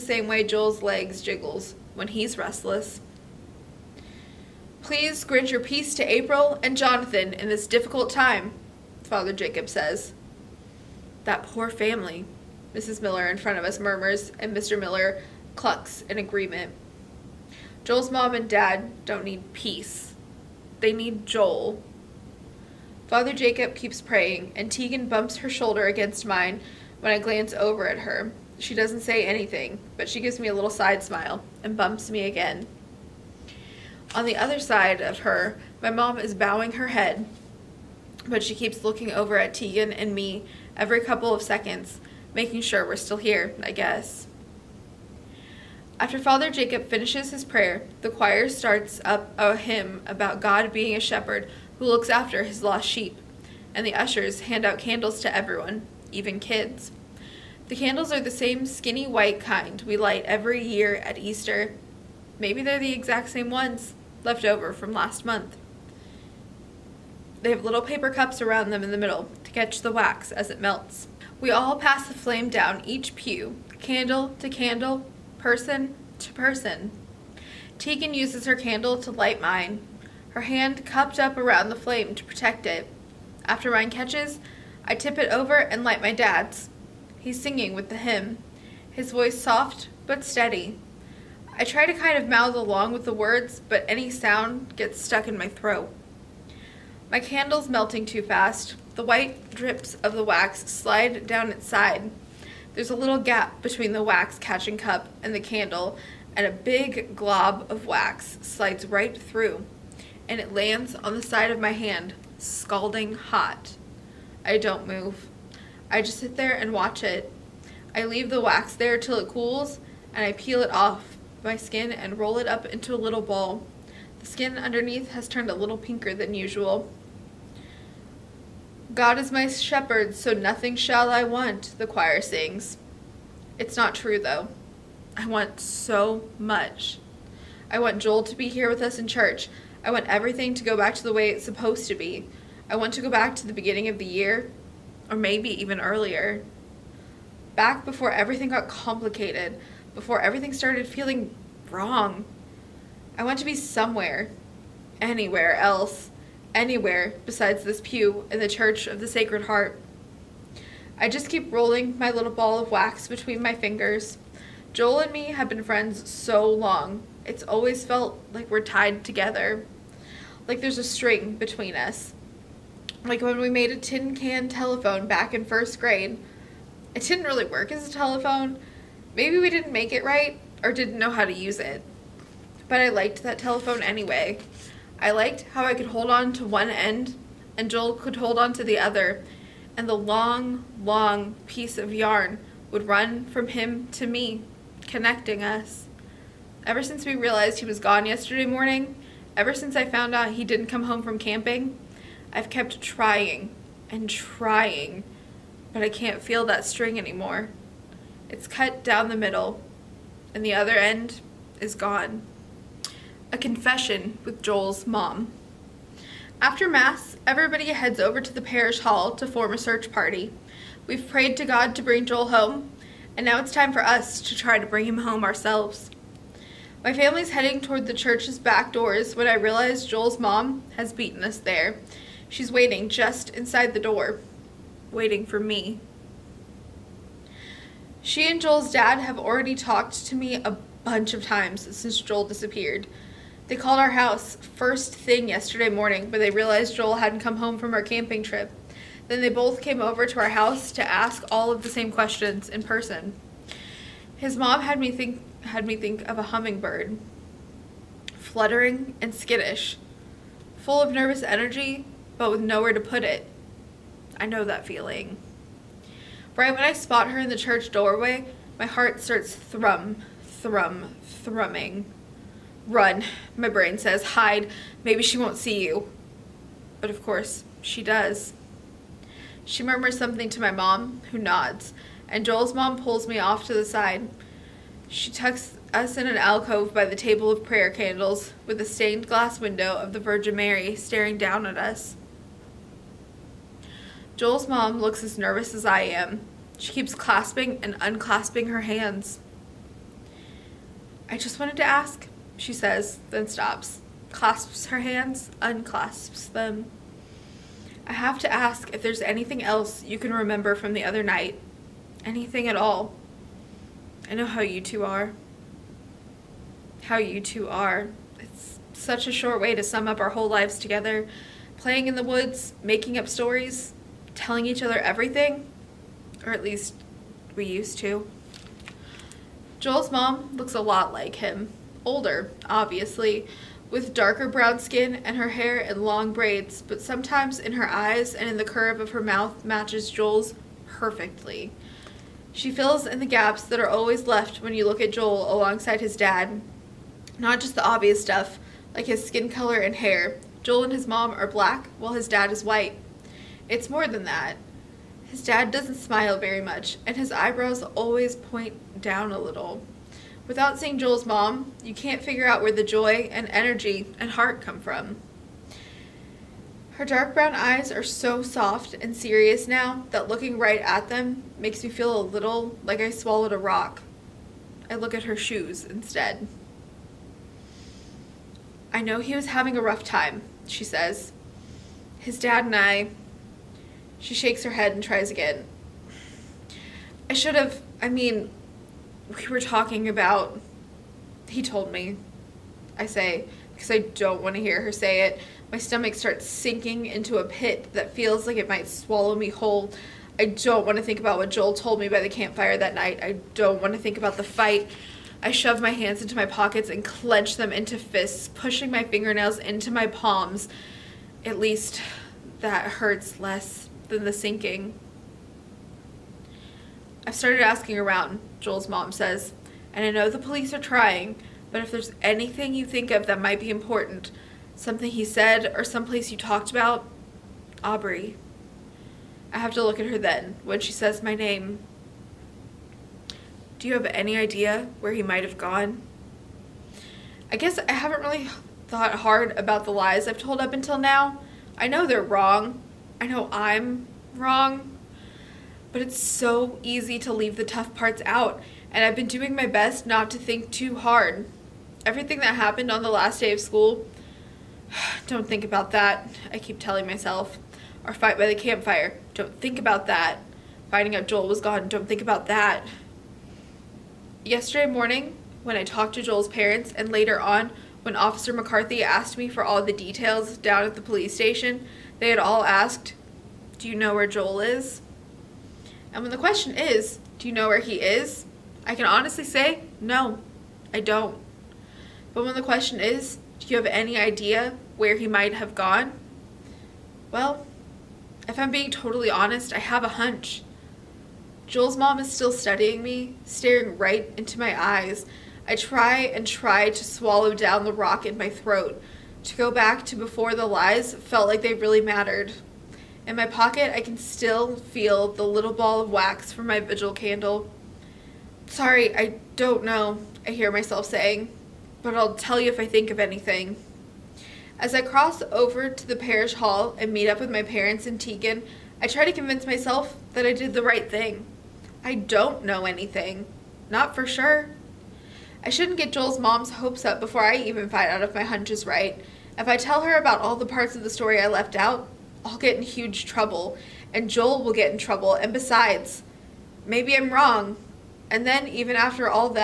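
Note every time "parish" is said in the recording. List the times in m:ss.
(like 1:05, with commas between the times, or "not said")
3:38, 8:35.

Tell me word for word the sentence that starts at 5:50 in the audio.
Joel and his mom are black, while his dad is white.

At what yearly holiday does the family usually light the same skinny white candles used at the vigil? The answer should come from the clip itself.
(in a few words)
Easter.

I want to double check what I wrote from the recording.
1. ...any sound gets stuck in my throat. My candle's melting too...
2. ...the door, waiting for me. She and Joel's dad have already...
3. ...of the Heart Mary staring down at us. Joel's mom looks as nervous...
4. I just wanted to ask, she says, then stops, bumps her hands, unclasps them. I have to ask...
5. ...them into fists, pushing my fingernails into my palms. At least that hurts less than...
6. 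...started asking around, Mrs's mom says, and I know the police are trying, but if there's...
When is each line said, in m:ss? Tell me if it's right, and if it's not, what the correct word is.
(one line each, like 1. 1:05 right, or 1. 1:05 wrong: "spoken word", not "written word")
1. 1:33 right
2. 3:53 right
3. 4:49 wrong: "Virgin", not "Heart"
4. 5:01 wrong: "clasps", not "bumps"
5. 6:47 right
6. 6:57 wrong: "Joel", not "Mrs".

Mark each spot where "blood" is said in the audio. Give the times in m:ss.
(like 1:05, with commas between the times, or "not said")
not said.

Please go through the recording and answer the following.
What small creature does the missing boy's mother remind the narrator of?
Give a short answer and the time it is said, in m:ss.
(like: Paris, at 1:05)
a hummingbird, at 4:16.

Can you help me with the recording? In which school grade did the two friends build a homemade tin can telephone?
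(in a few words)
first grade.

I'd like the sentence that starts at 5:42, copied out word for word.
She fills in the gaps that are always left when you look at Joel alongside his dad.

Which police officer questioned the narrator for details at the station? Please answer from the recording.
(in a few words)
Officer McCarthy.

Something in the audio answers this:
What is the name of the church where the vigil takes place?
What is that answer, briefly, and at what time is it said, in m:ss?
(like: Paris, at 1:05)
Church of the Sacred Heart, at 2:38.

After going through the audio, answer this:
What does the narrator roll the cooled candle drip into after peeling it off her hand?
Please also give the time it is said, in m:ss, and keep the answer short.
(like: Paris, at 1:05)
a little ball, at 2:02.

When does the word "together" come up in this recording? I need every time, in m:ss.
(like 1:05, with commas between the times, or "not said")
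2:49, 5:20.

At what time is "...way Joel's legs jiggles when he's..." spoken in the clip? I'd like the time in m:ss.
0:00.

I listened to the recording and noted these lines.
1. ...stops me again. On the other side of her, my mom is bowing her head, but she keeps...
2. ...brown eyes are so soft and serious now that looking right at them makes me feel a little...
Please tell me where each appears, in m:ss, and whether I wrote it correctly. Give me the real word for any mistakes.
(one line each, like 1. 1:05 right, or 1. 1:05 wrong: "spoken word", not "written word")
1. 0:31 wrong: "bumps", not "stops"
2. 6:07 right.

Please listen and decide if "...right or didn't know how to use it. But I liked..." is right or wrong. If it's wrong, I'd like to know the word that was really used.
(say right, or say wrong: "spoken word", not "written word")
right.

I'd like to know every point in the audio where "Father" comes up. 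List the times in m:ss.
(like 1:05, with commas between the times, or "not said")
0:09, 0:23, 0:46.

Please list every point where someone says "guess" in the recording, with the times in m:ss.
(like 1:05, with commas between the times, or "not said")
0:43, 7:17.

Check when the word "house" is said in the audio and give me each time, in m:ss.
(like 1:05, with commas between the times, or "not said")
4:03, 4:10.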